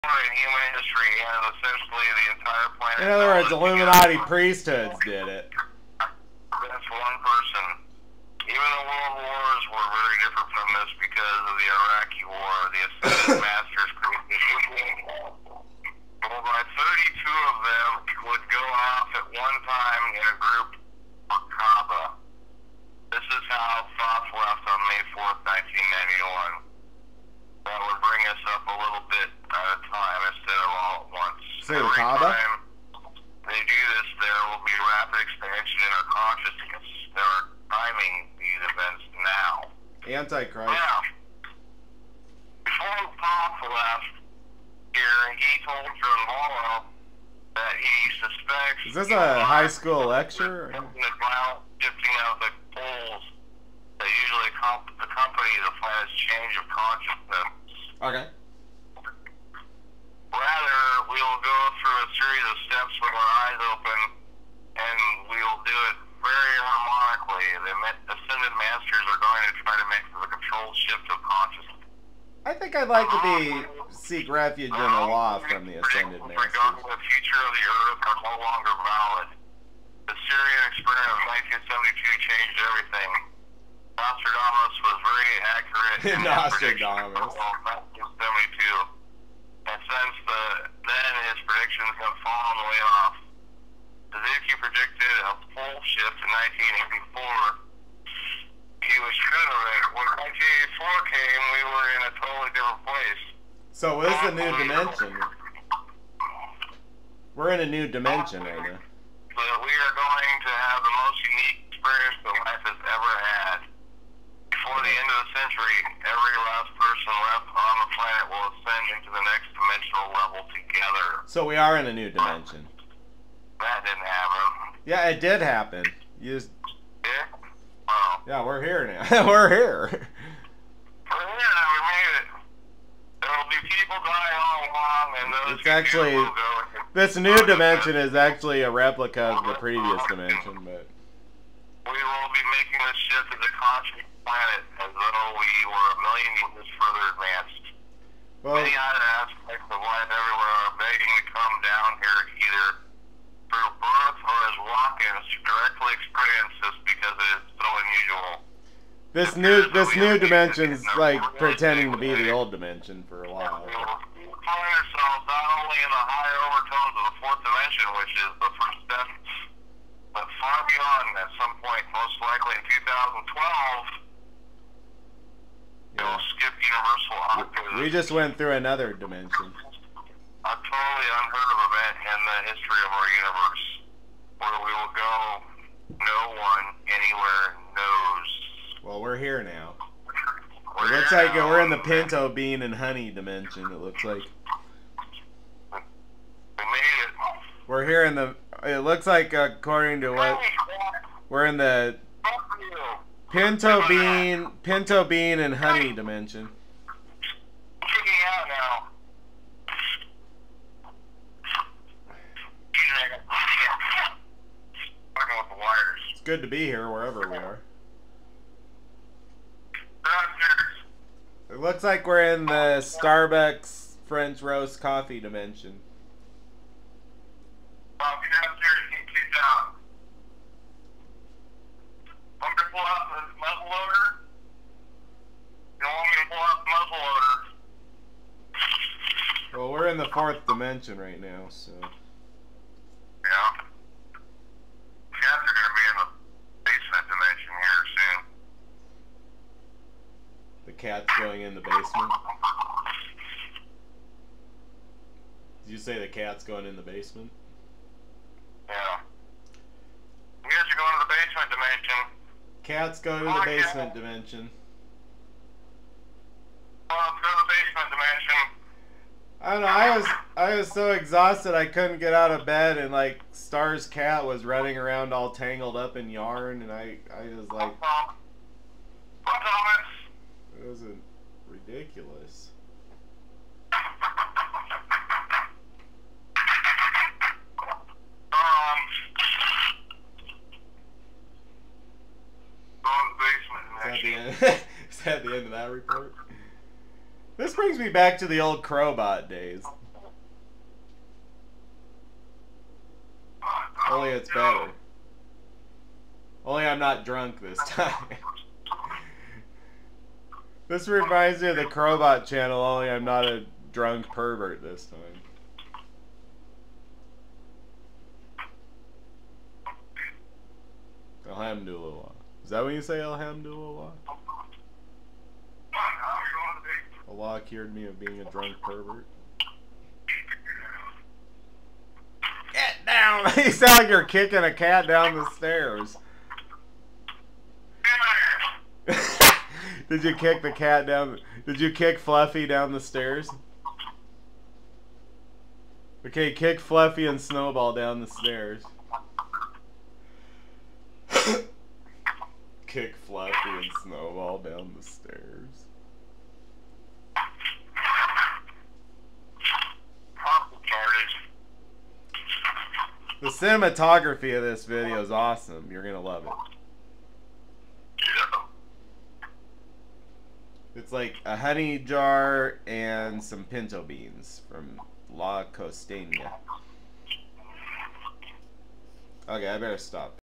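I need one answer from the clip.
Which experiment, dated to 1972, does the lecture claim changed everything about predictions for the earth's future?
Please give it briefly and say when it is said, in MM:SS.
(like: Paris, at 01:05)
The Sirian experiment, at 01:20.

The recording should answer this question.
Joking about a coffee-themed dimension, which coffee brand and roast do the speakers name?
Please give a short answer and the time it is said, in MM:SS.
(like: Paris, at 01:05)
Starbucks French roast, at 03:42.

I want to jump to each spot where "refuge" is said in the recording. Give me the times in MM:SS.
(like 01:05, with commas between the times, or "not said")
01:14.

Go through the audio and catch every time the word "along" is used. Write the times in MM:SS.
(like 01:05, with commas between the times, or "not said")
02:14.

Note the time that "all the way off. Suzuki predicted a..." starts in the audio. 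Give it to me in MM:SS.
01:32.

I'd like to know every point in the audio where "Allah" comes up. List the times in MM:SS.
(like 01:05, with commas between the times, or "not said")
05:27.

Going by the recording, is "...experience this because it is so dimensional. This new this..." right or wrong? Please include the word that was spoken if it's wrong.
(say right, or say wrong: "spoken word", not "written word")
wrong: "unusual", not "dimensional".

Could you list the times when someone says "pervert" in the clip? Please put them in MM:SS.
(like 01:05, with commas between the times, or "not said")
05:14, 05:28.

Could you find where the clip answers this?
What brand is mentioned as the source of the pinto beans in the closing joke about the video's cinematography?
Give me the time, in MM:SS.
06:15.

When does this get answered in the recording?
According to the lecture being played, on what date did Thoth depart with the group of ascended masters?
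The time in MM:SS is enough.
00:24.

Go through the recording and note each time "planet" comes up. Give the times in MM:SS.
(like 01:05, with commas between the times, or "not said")
00:02, 00:55, 01:57, 02:24.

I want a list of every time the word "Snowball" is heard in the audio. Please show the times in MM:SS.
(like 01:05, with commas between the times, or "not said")
05:47, 05:53.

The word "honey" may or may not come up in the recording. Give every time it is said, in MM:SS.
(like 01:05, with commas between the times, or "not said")
03:12, 03:25, 06:11.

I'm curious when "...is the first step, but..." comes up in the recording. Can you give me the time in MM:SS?
02:48.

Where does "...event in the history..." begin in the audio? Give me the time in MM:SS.
03:01.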